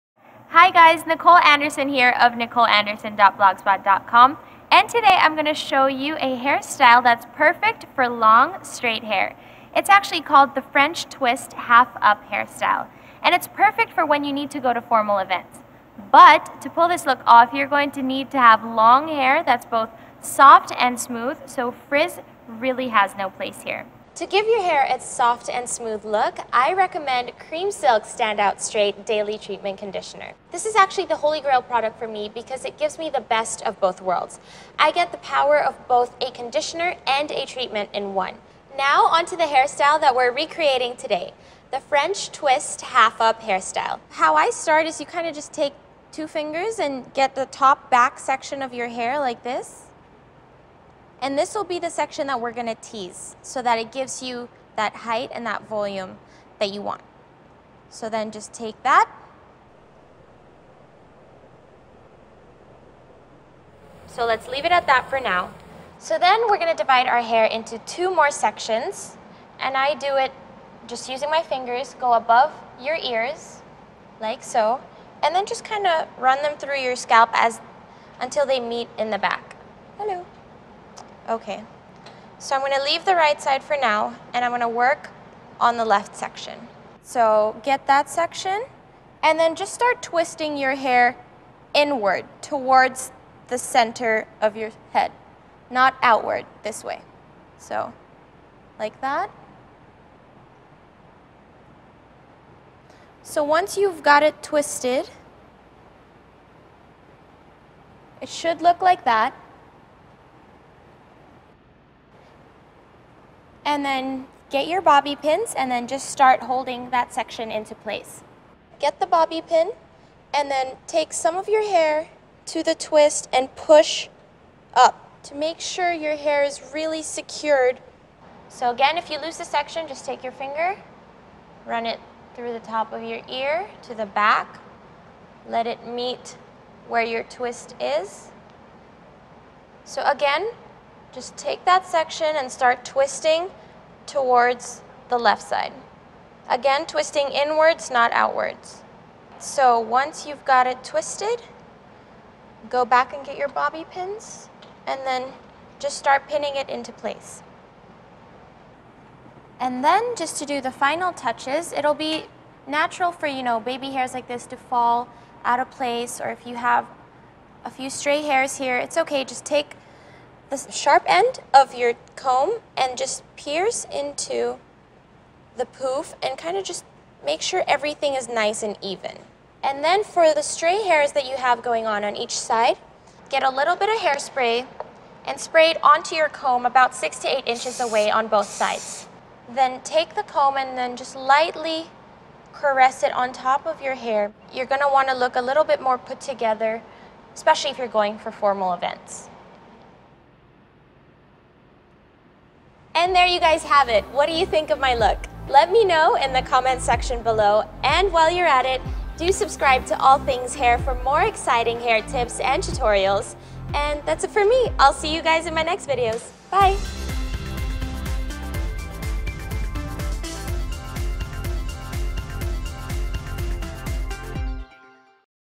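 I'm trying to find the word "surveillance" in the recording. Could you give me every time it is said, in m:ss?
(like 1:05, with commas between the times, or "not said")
not said.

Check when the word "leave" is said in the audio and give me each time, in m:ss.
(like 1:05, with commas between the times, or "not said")
1:04, 1:22.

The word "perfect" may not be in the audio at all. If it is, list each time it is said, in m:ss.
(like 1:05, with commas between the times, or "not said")
0:07, 0:13.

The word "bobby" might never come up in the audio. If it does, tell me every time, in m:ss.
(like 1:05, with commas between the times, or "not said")
1:54, 1:59, 2:33.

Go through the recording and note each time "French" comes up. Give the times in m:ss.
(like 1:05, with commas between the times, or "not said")
0:10, 0:41.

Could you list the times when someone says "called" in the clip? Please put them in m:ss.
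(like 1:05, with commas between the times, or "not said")
0:10.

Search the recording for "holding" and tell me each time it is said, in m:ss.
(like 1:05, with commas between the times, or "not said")
1:56.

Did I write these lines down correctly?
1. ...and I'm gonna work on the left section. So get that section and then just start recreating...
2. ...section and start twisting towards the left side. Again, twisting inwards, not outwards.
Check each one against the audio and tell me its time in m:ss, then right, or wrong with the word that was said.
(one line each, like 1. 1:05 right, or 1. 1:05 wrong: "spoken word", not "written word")
1. 1:24 wrong: "twisting", not "recreating"
2. 2:21 right.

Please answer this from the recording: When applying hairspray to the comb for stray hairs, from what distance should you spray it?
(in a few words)
6 to 8 inches.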